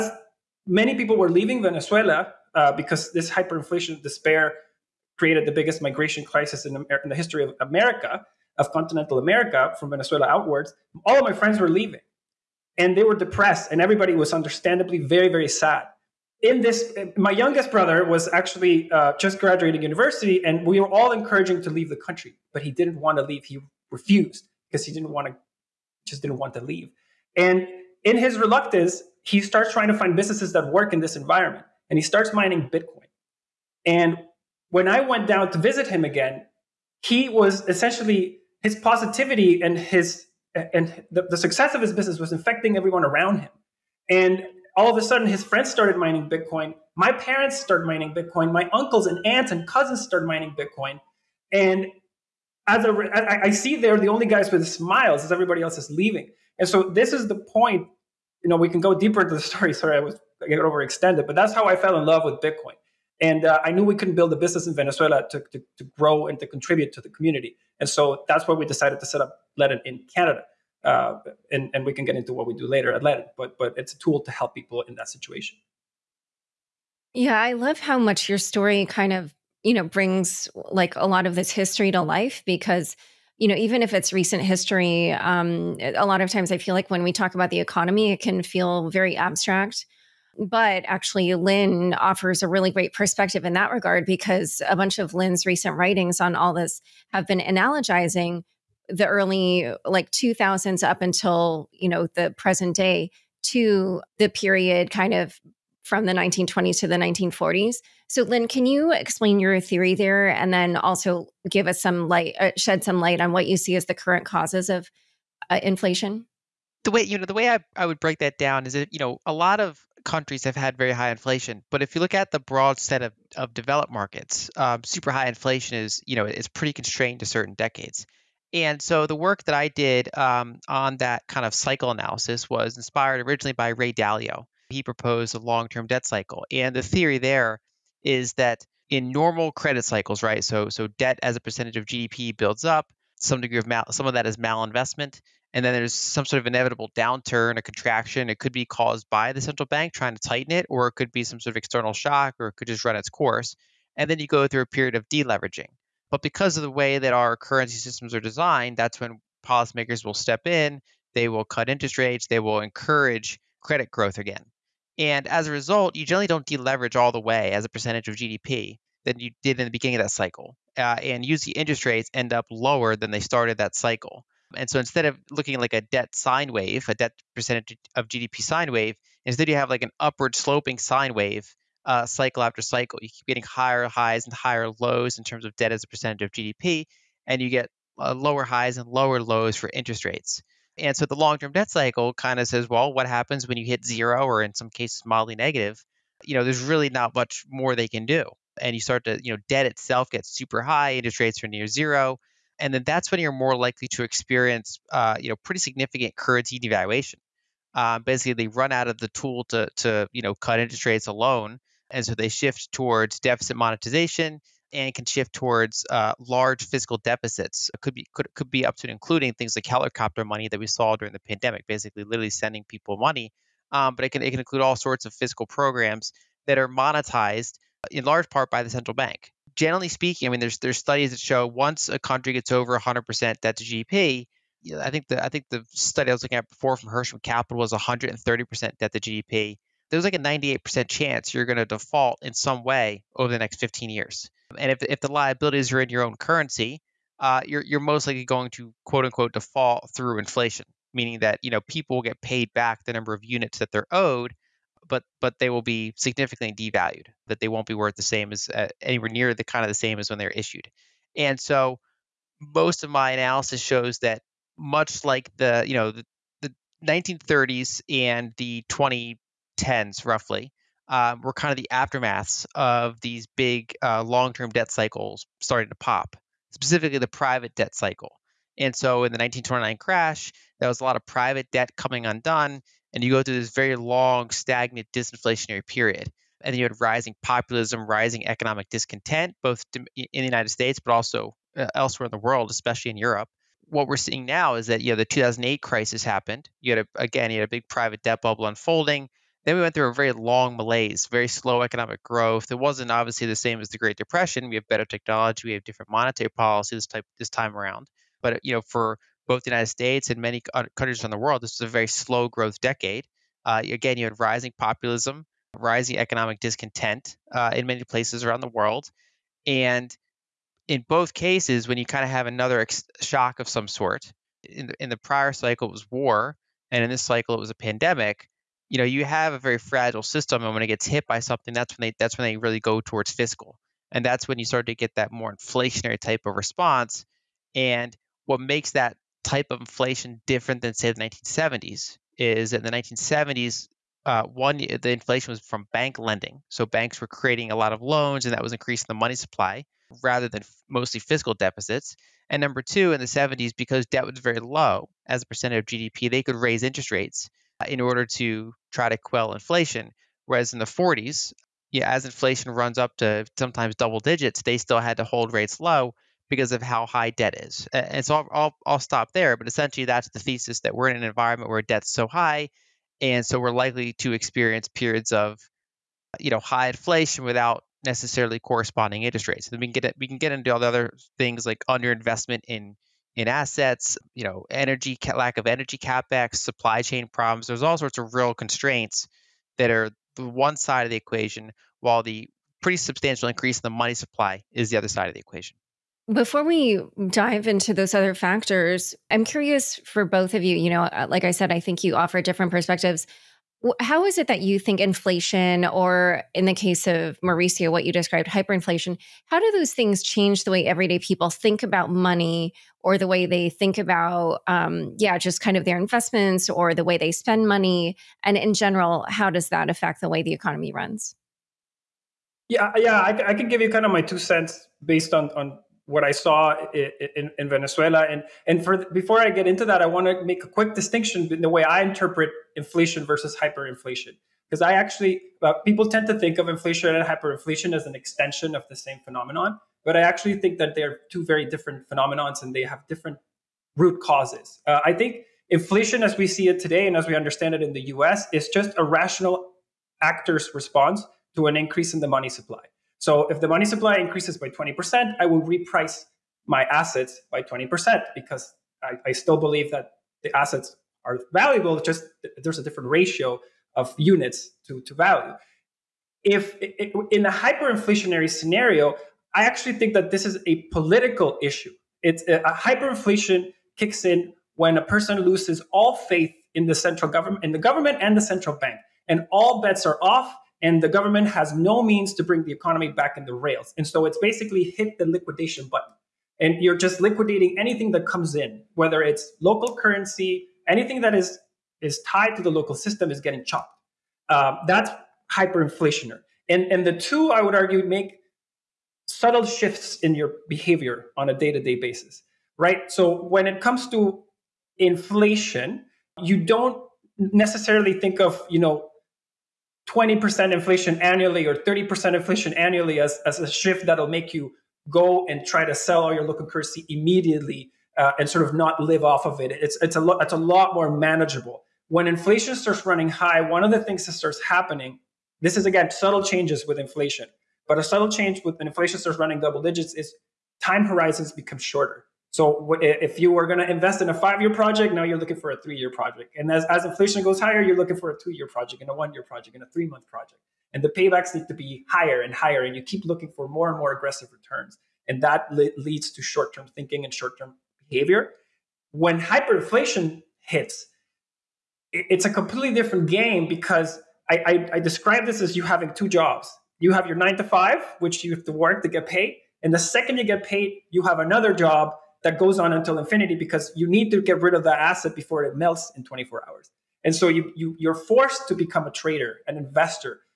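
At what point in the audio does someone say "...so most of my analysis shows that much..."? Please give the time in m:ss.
4:21.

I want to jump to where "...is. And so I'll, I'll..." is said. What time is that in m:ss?
6:07.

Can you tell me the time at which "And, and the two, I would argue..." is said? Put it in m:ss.
8:16.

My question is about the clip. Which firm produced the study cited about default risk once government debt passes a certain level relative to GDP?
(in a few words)
Hirschmann Capital.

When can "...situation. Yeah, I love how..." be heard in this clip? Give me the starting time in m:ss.
1:15.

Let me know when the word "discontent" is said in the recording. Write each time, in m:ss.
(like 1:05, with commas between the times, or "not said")
4:48, 5:16.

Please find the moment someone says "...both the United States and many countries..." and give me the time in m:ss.
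5:09.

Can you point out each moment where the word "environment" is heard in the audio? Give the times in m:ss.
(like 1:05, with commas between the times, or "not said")
0:31, 6:11.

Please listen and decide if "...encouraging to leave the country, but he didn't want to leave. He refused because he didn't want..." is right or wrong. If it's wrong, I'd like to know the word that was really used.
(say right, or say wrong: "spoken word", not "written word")
right.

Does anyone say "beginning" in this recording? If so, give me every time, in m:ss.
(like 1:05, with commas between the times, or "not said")
2:49.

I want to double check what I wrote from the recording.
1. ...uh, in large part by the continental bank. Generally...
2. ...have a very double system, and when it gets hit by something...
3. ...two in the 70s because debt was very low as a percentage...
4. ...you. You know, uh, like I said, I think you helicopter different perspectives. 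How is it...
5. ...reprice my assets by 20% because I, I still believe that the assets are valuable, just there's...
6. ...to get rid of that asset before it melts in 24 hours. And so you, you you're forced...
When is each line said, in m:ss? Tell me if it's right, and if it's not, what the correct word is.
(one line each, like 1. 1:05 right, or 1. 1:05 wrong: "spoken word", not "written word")
1. 3:47 wrong: "central", not "continental"
2. 5:29 wrong: "fragile", not "double"
3. 5:52 right
4. 6:40 wrong: "offer", not "helicopter"
5. 7:35 right
6. 9:24 right.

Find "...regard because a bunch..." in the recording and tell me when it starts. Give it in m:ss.
1:33.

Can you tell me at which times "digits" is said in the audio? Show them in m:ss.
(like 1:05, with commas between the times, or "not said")
6:03, 8:49.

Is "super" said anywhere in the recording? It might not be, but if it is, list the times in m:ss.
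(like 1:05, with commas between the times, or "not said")
2:04, 3:20.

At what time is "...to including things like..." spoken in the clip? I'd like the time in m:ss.
3:38.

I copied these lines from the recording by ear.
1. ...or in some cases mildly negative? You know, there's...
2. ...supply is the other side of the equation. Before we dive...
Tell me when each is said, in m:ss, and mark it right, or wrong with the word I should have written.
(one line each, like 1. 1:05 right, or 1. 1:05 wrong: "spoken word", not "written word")
1. 3:14 right
2. 6:33 right.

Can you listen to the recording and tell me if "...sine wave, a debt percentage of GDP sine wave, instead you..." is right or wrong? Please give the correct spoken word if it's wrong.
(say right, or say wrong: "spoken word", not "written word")
right.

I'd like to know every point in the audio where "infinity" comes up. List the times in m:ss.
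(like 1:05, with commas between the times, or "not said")
9:22.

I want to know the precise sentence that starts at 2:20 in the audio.
So, so debt as a percentage of GDP builds up.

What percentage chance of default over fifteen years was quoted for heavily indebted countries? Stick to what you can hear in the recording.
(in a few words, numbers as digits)
98%.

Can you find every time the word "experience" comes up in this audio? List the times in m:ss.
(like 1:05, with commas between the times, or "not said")
3:24, 6:14.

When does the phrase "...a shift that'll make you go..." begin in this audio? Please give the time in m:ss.
8:33.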